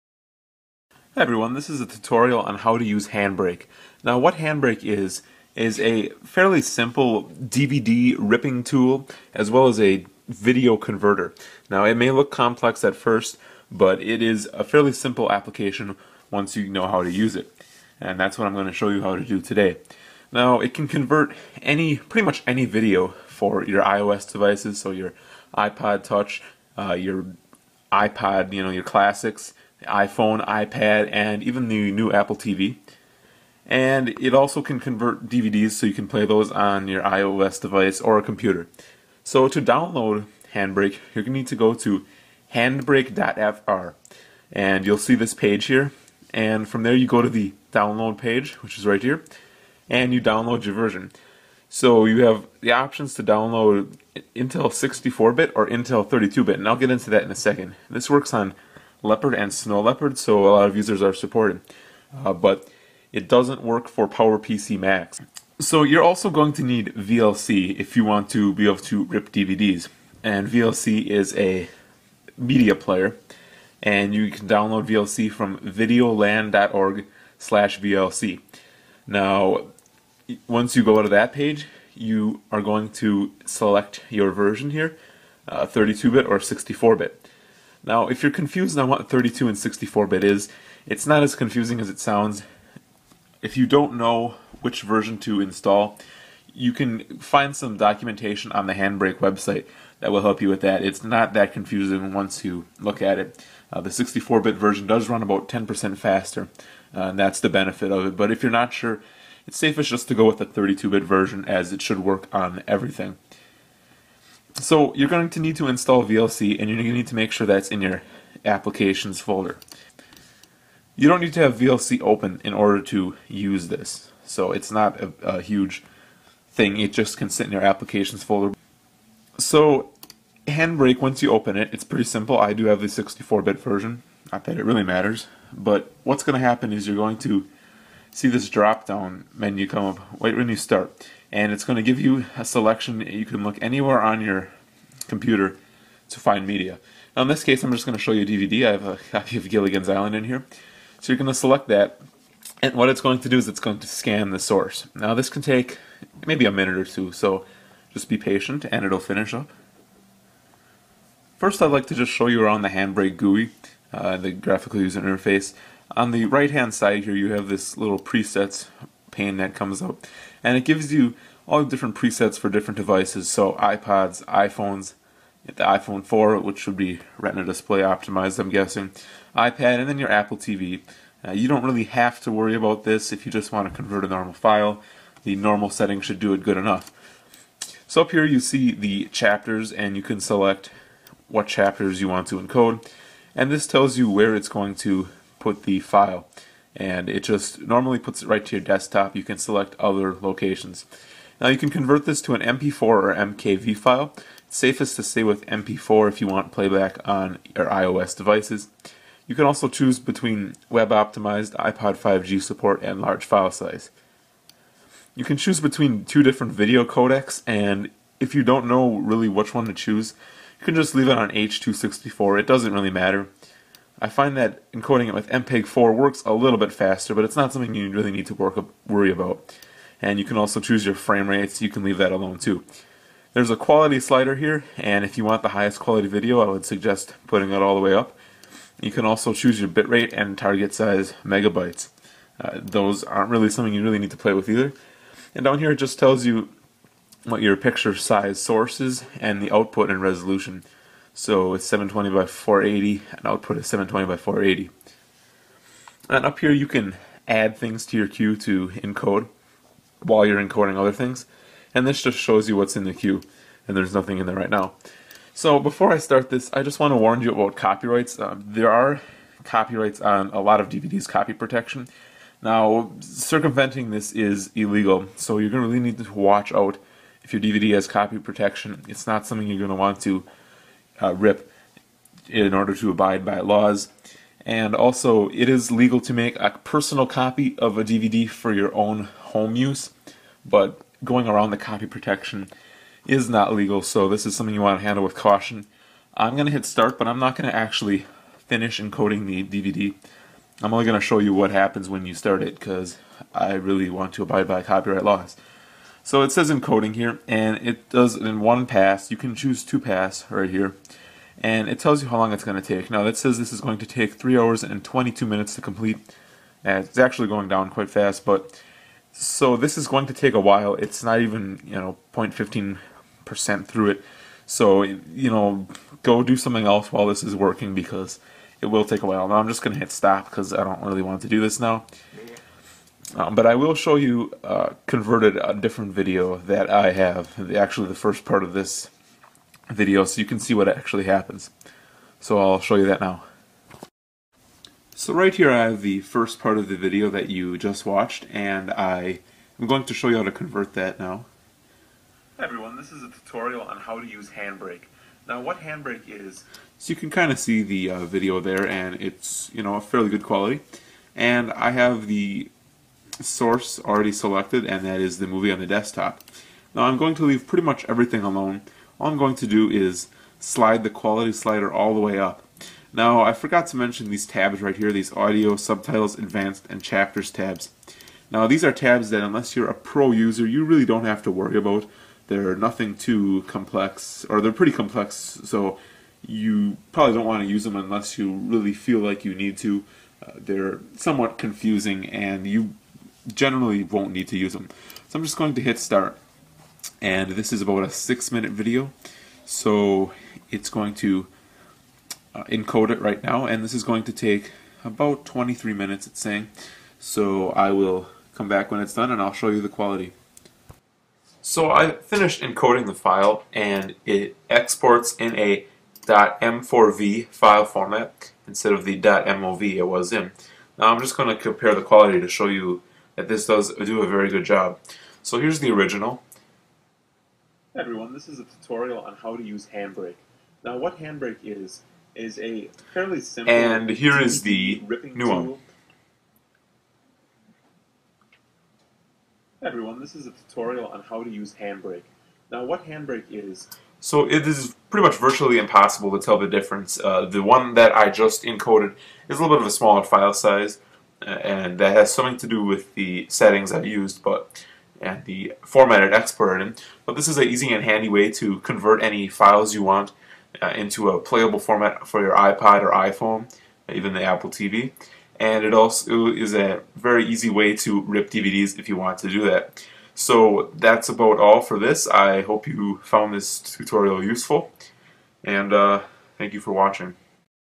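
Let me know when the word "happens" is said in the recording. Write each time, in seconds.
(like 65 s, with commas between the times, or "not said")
136 s, 301 s, 341 s.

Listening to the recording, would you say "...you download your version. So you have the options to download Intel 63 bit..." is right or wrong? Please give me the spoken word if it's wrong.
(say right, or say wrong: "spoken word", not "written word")
wrong: "64", not "63".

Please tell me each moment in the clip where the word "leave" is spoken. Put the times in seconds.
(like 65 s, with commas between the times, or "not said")
220 s, 231 s, 367 s.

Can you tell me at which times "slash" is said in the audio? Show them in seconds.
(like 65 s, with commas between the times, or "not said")
77 s.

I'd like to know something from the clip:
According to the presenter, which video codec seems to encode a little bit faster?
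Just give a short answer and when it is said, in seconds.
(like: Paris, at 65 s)
MPEG-4, at 225 s.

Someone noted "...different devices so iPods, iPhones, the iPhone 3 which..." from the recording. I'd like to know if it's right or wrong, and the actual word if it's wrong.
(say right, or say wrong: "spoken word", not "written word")
wrong: "4", not "3".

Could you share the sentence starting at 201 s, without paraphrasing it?
Now you can convert this to an MP4 or MKV file.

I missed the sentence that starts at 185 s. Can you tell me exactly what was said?
The normal setting should do it good enough.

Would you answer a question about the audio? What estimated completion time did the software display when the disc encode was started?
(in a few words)
3 hours and 22 minutes.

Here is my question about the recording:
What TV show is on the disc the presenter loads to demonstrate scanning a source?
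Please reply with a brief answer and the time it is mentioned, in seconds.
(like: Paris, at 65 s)
Gilligan's Island, at 149 s.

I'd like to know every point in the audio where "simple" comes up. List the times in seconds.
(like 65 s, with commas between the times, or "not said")
6 s, 14 s, 132 s, 433 s.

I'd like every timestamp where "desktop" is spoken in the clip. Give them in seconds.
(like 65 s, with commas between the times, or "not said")
198 s, 365 s.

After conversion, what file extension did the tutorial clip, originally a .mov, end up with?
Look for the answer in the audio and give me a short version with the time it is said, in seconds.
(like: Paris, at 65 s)
.m4v, at 416 s.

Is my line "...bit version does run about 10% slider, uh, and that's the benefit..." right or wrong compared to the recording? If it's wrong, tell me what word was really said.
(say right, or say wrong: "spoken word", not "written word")
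wrong: "faster", not "slider".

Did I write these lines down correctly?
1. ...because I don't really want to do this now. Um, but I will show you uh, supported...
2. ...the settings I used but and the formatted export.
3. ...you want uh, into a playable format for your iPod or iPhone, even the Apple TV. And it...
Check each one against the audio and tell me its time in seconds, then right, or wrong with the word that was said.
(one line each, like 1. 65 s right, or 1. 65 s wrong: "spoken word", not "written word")
1. 330 s wrong: "converted", not "supported"
2. 452 s right
3. 459 s right.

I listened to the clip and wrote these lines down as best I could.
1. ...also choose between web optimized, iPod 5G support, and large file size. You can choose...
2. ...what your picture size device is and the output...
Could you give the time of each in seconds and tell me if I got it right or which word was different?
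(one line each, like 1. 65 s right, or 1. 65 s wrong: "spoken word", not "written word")
1. 209 s right
2. 247 s wrong: "source", not "device".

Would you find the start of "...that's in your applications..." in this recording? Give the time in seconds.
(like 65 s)
117 s.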